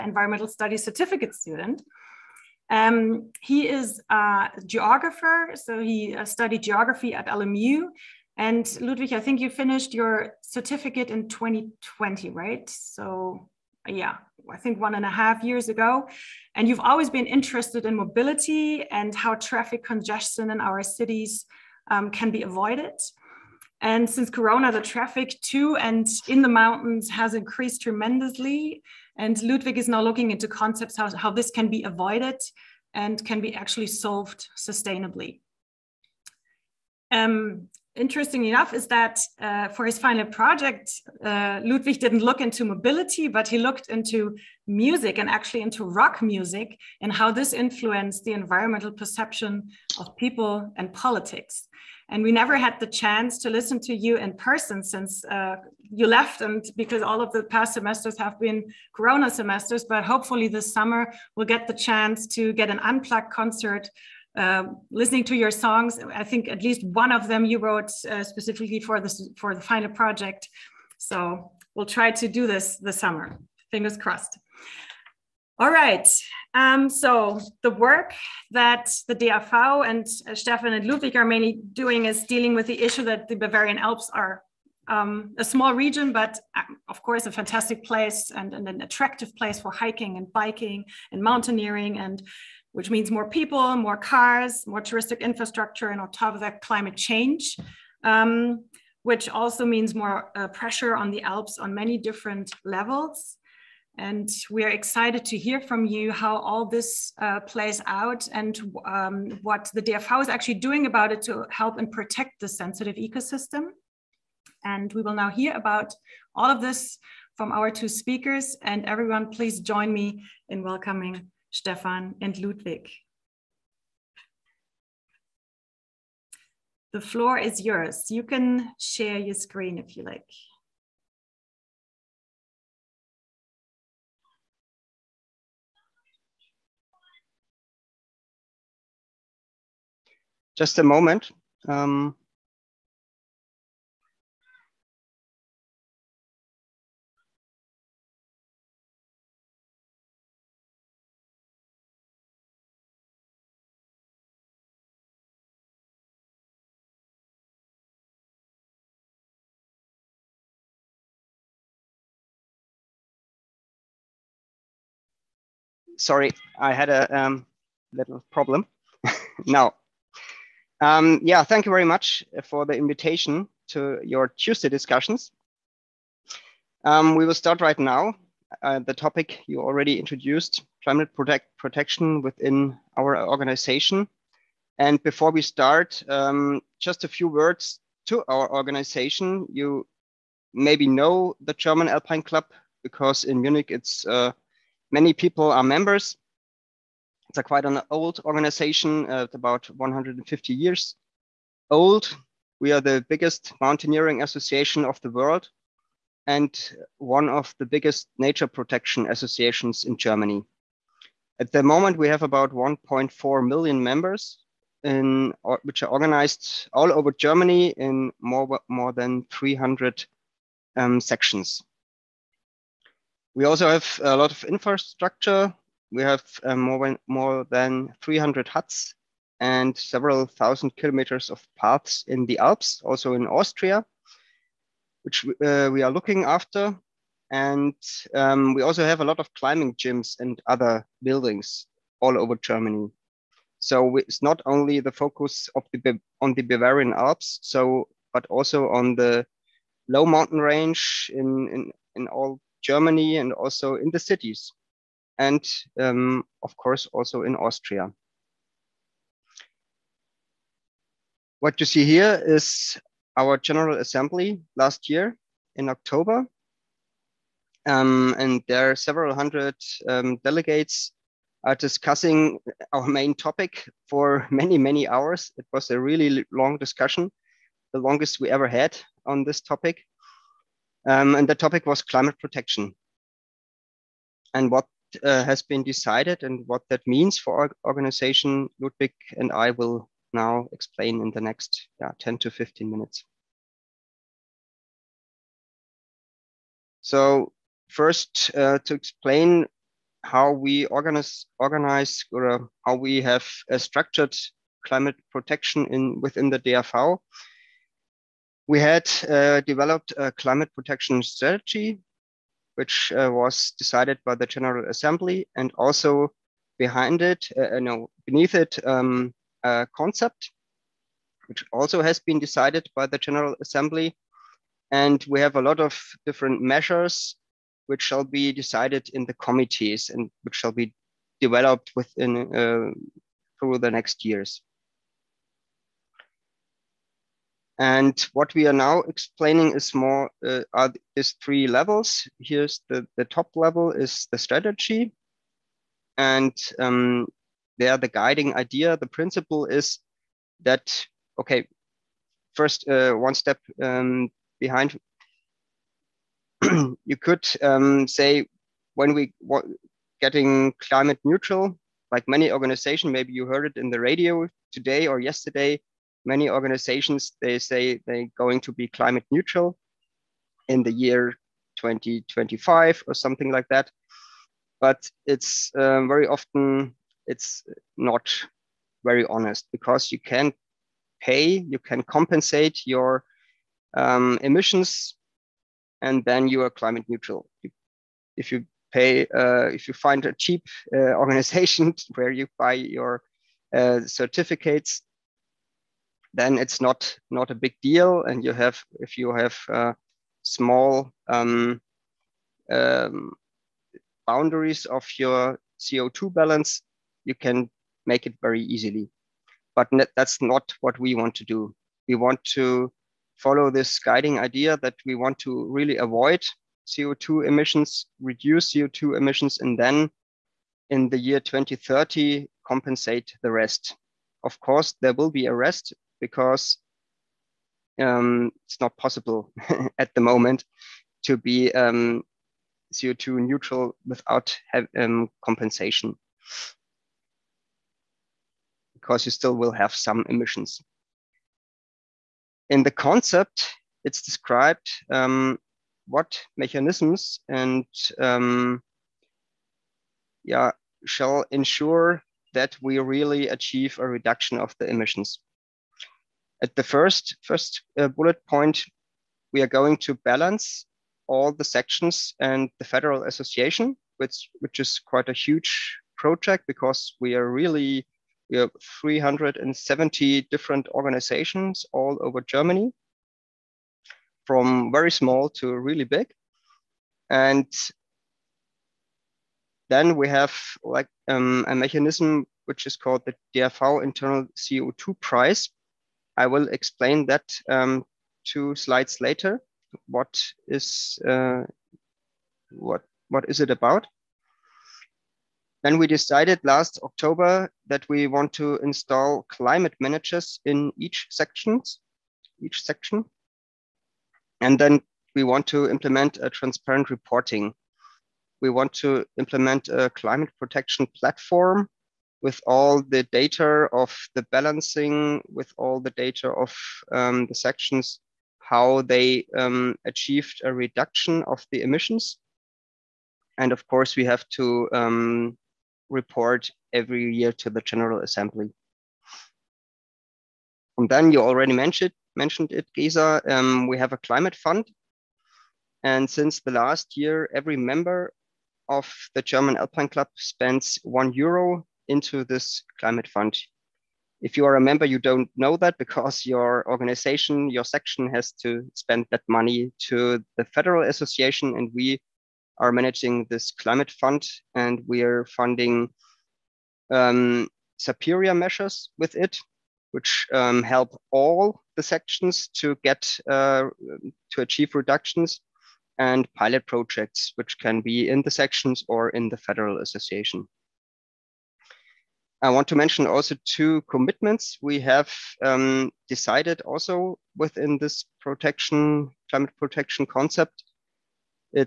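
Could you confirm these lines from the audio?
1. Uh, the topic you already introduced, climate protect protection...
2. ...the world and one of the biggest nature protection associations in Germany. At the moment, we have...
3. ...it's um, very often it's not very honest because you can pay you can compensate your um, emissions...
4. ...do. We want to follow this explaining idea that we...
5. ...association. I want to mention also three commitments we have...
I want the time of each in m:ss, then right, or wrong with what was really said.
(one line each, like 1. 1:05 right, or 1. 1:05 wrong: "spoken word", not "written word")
1. 2:58 right
2. 3:24 right
3. 6:15 right
4. 6:51 wrong: "guiding", not "explaining"
5. 9:29 wrong: "two", not "three".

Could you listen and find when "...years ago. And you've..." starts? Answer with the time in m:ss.
0:15.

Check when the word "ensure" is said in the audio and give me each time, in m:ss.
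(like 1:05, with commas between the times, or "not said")
7:31.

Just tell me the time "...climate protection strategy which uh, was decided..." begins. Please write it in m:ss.
5:10.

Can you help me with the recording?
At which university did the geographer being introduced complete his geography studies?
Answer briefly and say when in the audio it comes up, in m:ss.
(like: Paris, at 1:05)
LMU, at 0:07.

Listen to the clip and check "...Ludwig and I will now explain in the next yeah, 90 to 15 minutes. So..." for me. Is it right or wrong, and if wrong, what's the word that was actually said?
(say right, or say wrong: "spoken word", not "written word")
wrong: "10", not "90".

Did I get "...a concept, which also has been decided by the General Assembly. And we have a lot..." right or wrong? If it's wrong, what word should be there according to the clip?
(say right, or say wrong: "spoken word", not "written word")
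right.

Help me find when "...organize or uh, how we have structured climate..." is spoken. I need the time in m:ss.
5:01.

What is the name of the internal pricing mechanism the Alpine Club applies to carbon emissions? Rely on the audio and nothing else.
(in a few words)
DAV internal CO2 price.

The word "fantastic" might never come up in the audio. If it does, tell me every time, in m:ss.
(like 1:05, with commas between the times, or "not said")
1:27.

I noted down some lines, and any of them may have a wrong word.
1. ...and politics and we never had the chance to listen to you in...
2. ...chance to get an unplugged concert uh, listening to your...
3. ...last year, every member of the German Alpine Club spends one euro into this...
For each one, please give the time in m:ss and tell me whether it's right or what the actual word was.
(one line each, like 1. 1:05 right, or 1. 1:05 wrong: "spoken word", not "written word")
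1. 0:50 right
2. 1:01 right
3. 8:56 right.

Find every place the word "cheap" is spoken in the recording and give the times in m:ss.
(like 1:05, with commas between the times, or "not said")
6:30.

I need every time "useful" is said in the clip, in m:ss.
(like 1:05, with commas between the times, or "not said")
not said.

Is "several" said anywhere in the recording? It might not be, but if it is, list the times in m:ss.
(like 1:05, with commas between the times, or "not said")
3:49, 4:28.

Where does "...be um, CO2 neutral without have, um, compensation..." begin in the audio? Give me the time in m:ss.
7:11.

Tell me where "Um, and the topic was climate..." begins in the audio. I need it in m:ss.
4:40.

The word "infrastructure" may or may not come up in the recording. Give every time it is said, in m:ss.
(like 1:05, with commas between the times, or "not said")
1:35, 3:44.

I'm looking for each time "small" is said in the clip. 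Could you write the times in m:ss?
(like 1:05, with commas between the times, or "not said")
1:25, 6:40, 7:54.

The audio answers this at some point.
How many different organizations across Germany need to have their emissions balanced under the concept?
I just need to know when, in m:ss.
7:48.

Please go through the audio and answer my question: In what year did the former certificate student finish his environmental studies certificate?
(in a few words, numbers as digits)
2020.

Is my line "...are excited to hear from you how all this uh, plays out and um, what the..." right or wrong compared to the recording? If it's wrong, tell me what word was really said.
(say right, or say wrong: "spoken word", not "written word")
right.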